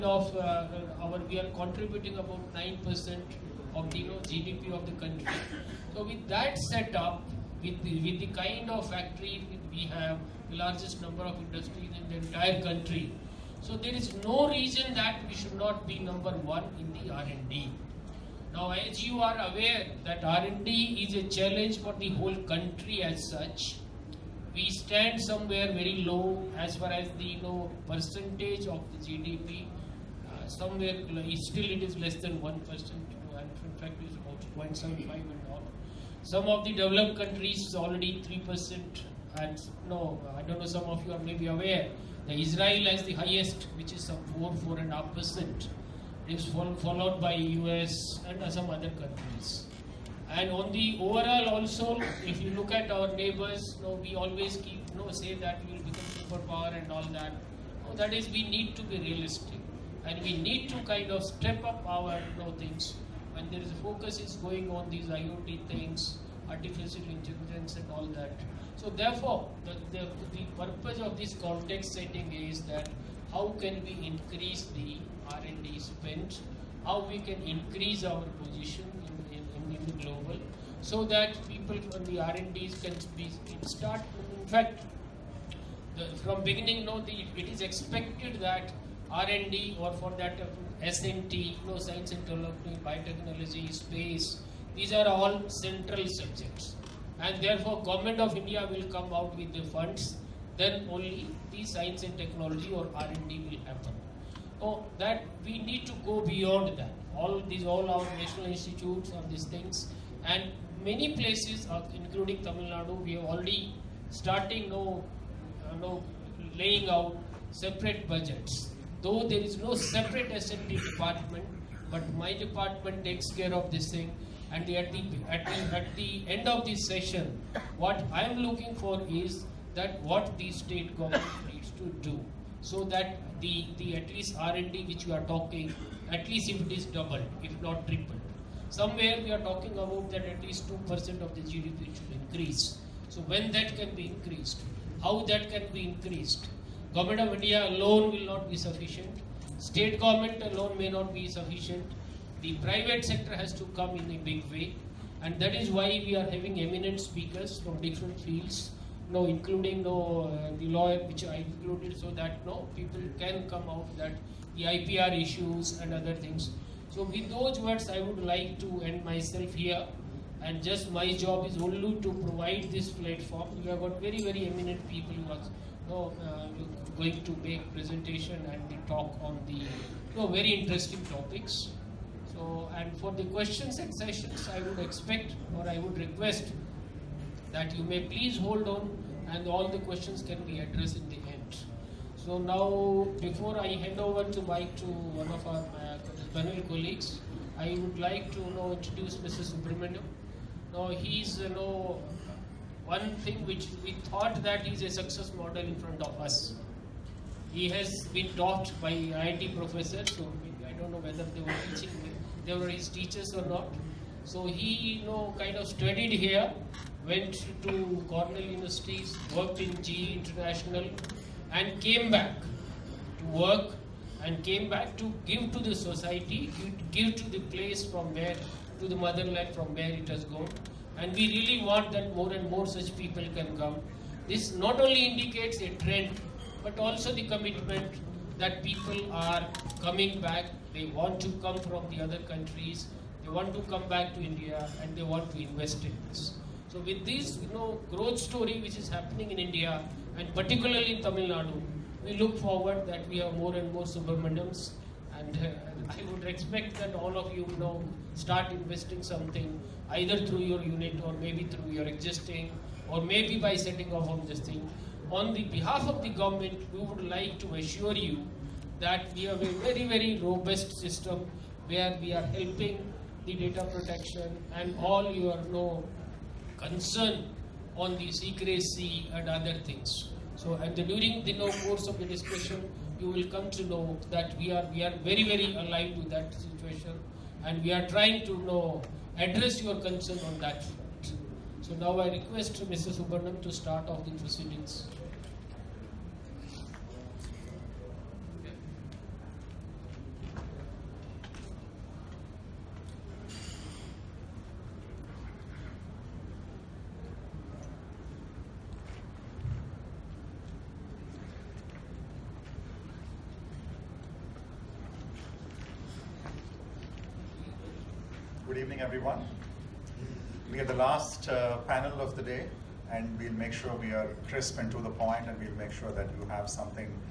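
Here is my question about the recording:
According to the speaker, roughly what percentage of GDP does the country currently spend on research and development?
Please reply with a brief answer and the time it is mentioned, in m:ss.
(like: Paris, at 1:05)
0.75, at 0:34.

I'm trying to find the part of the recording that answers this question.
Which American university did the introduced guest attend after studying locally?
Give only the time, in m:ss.
3:38.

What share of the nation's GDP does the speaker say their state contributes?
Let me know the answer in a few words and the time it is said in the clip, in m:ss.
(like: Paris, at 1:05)
9%, at 0:02.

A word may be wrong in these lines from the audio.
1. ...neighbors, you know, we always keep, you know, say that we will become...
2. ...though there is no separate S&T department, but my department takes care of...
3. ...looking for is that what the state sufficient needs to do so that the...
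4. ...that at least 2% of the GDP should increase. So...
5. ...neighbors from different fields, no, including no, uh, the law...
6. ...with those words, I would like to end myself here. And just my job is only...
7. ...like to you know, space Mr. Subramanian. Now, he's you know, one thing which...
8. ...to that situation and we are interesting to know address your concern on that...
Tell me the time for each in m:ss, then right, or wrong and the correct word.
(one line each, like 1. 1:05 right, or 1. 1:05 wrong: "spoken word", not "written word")
1. 0:53 right
2. 1:59 right
3. 2:08 wrong: "government", not "sufficient"
4. 2:20 right
5. 2:36 wrong: "speakers", not "neighbors"
6. 2:47 right
7. 3:17 wrong: "introduce", not "space"
8. 4:45 wrong: "trying", not "interesting".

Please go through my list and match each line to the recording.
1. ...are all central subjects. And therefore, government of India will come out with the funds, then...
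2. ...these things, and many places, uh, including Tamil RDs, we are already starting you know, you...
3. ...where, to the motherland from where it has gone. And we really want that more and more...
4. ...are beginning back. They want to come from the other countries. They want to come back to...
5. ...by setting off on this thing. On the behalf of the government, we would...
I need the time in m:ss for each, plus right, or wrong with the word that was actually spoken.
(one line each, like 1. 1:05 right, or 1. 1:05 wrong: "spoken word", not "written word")
1. 1:34 right
2. 1:49 wrong: "Nadu", not "RDs"
3. 3:48 right
4. 3:59 wrong: "coming", not "beginning"
5. 4:23 right.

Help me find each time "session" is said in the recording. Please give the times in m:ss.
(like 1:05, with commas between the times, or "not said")
2:06, 3:03.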